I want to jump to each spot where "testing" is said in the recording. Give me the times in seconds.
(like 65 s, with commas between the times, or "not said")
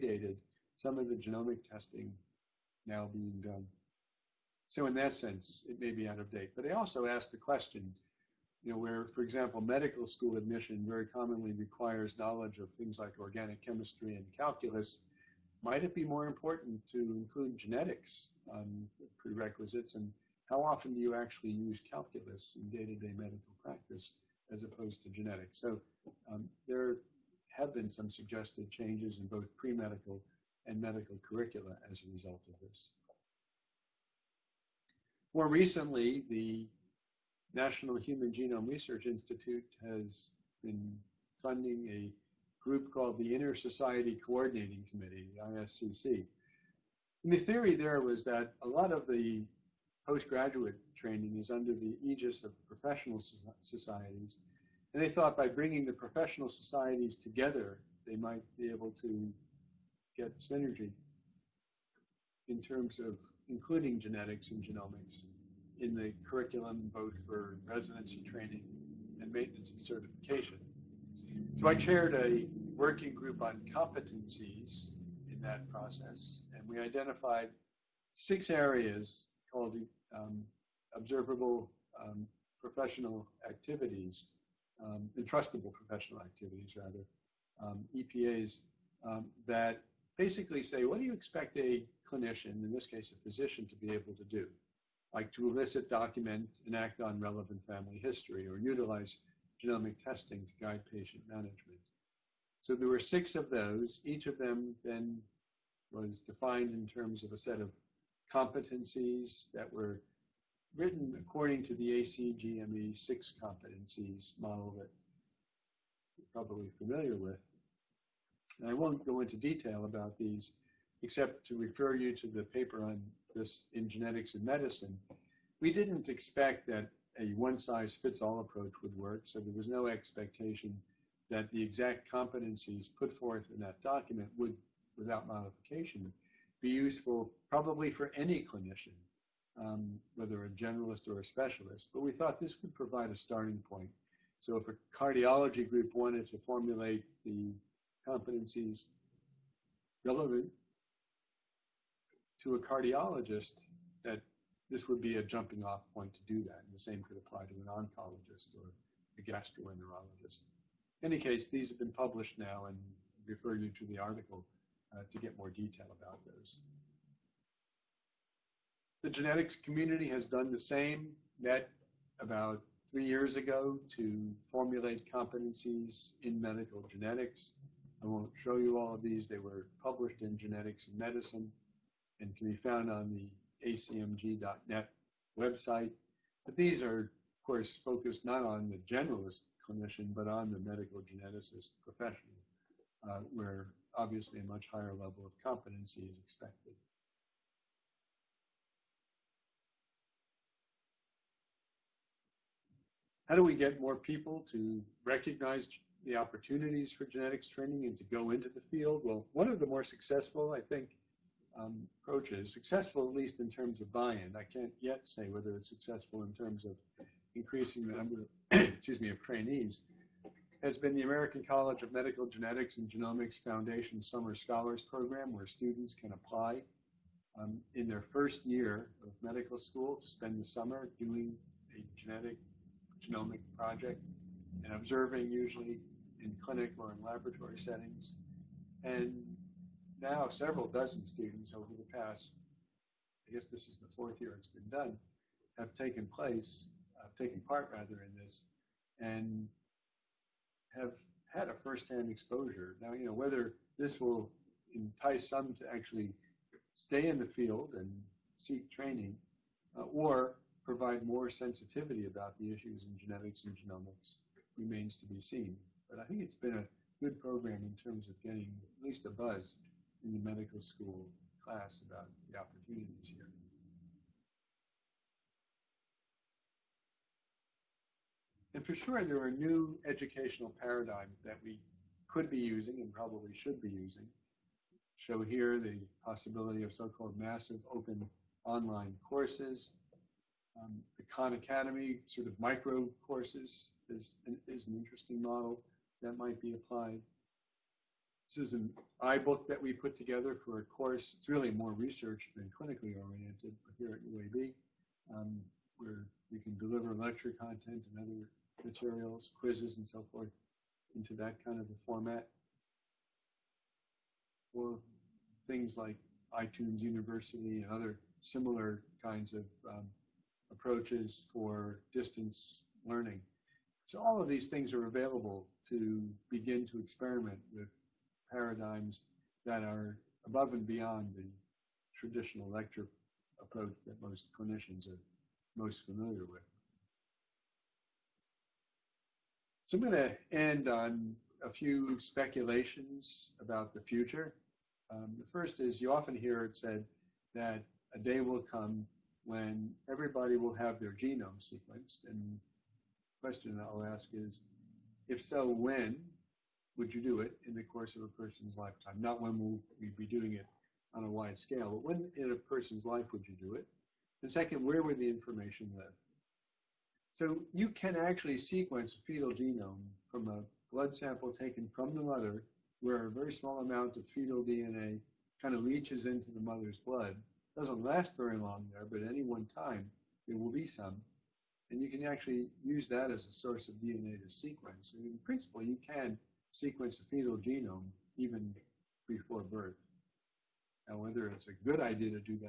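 1 s, 100 s.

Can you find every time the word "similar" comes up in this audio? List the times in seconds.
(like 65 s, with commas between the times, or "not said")
318 s.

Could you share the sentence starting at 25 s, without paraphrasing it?
So um, there have been some suggested changes in both pre-medical and medical curricula as a result of this.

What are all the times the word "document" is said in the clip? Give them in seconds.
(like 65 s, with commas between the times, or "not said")
95 s, 133 s.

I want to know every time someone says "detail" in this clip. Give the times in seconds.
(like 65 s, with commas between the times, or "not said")
119 s, 165 s.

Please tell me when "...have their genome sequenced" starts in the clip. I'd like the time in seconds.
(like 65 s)
350 s.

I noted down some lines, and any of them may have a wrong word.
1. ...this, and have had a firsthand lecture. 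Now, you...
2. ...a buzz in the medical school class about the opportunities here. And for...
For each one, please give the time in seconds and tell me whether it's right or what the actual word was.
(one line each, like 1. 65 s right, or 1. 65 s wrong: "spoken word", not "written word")
1. 248 s wrong: "exposure", not "lecture"
2. 269 s right.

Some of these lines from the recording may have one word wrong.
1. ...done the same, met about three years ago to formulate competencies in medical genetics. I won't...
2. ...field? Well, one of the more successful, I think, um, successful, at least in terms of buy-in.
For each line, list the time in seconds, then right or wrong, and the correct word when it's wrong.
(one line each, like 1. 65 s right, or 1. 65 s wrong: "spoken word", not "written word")
1. 170 s right
2. 208 s right.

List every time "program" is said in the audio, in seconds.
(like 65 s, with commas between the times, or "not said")
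224 s, 267 s.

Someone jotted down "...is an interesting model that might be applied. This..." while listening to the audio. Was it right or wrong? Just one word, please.
right.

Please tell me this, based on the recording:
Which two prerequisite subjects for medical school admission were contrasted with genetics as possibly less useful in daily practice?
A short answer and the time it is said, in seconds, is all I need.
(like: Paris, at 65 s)
Organic chemistry and calculus, at 13 s.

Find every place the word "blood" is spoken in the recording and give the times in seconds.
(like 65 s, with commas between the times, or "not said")
370 s, 376 s.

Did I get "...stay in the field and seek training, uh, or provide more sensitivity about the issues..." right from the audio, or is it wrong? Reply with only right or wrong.
right.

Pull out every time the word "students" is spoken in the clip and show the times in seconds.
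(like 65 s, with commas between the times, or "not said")
225 s, 241 s.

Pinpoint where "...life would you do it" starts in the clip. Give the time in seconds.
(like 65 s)
362 s.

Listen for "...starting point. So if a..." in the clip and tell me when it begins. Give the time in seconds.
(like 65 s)
143 s.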